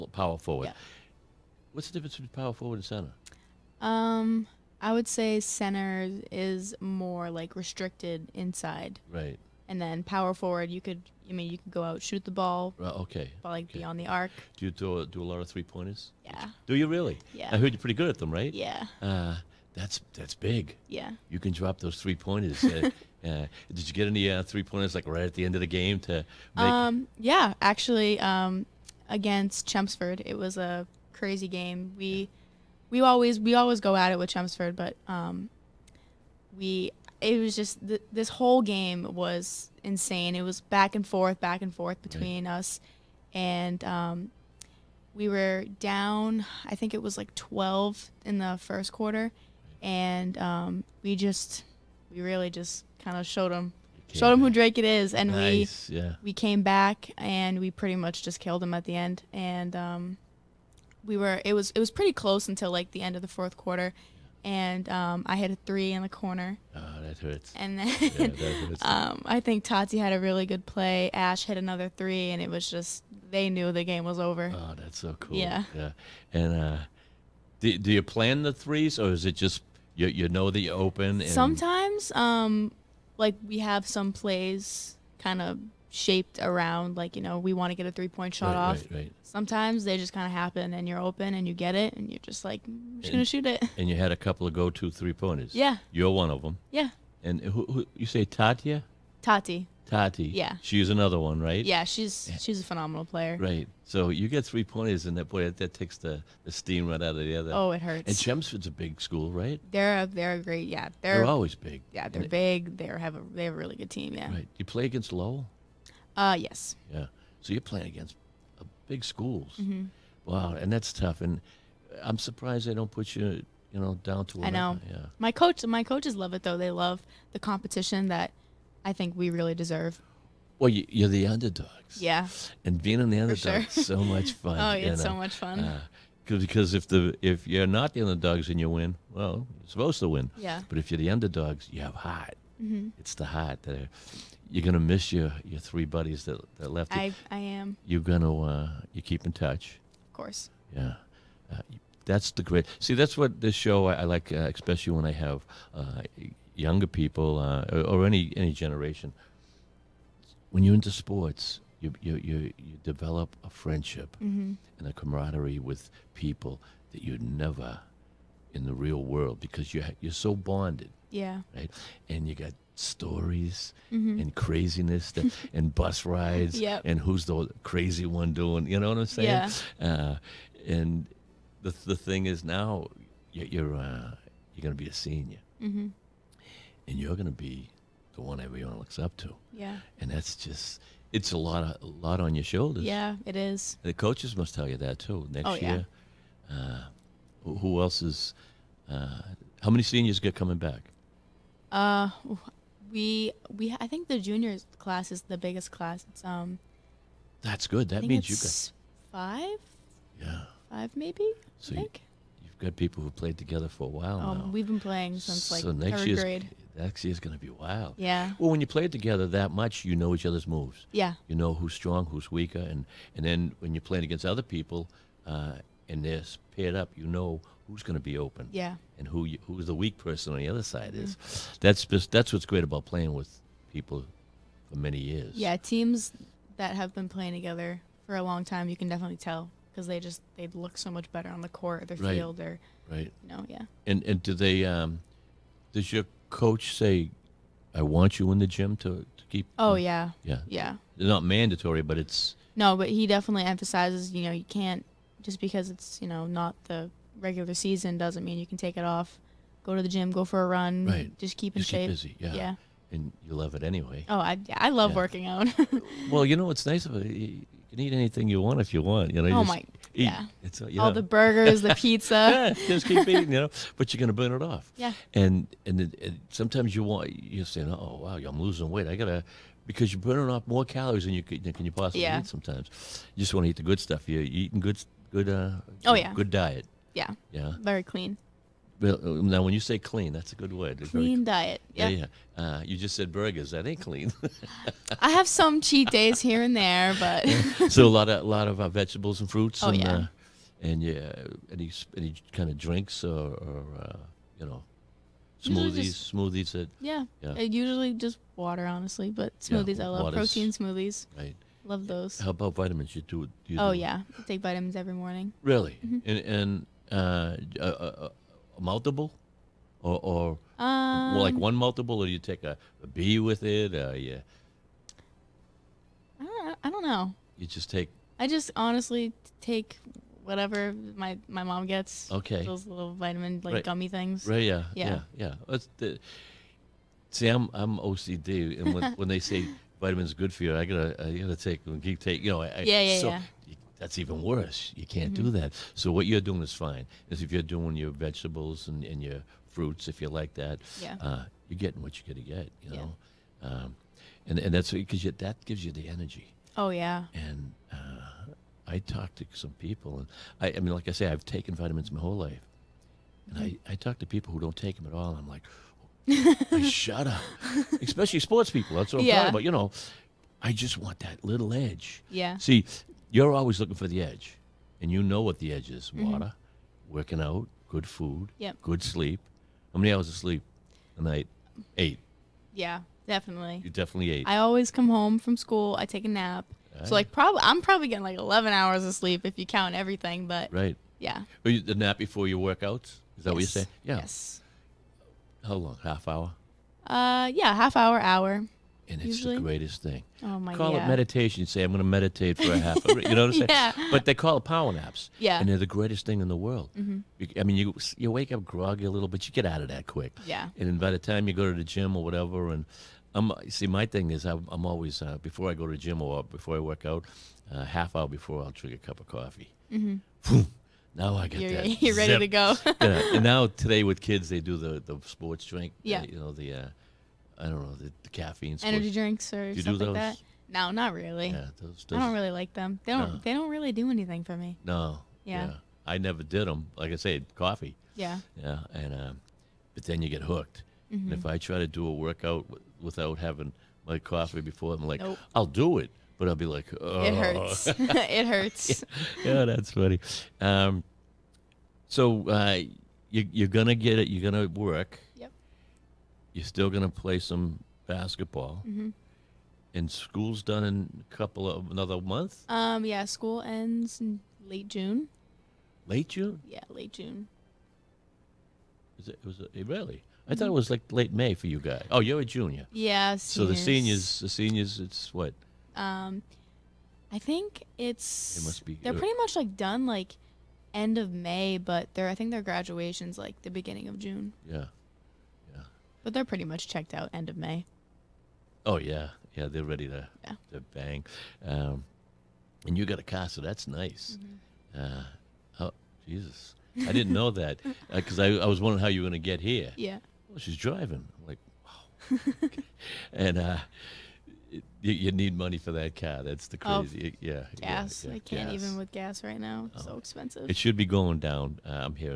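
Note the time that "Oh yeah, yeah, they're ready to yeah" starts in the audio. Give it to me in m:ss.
8:08.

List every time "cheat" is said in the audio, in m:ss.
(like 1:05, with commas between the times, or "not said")
4:55.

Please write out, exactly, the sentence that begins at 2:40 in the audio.
When you're into sports, you you you, you develop a friendship mm-hmm.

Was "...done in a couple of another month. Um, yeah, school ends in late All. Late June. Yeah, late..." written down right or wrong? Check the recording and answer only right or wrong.
wrong.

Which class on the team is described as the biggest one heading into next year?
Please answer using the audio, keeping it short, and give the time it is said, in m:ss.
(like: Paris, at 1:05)
the juniors, at 3:24.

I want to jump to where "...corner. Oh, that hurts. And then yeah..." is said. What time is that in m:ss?
1:06.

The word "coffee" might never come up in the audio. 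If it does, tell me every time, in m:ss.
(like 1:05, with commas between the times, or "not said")
6:59, 7:17, 7:23.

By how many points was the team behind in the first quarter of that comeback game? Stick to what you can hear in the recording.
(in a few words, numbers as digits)
12.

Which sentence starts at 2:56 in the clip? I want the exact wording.
and who's the crazy one doing you know what i'm saying yeah.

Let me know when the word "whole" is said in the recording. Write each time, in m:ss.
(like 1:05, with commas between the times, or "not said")
0:38, 6:02.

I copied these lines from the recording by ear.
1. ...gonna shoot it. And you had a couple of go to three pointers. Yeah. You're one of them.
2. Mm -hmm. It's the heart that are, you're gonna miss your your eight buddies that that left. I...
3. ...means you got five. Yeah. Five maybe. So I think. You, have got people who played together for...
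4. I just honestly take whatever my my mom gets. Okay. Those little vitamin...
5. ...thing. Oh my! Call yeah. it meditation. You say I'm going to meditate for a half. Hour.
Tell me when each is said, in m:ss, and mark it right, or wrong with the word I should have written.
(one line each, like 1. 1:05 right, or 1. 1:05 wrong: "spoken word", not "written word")
1. 1:33 right
2. 2:22 wrong: "three", not "eight"
3. 3:28 right
4. 5:28 right
5. 6:39 right.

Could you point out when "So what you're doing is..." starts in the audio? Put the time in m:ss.
5:45.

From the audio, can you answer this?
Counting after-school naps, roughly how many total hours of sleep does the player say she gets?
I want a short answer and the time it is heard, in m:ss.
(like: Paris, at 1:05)
11, at 6:28.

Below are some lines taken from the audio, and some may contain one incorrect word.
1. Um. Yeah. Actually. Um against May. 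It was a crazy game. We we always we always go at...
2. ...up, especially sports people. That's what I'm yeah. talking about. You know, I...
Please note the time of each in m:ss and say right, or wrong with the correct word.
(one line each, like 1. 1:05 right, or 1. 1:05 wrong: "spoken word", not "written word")
1. 0:26 wrong: "Chelmsford", not "May"
2. 6:06 right.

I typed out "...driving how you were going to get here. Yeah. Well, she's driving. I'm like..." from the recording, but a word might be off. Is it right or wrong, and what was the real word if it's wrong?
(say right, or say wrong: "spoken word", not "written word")
wrong: "wondering", not "driving".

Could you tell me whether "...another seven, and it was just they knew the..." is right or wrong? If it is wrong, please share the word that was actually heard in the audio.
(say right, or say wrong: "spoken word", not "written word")
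wrong: "three", not "seven".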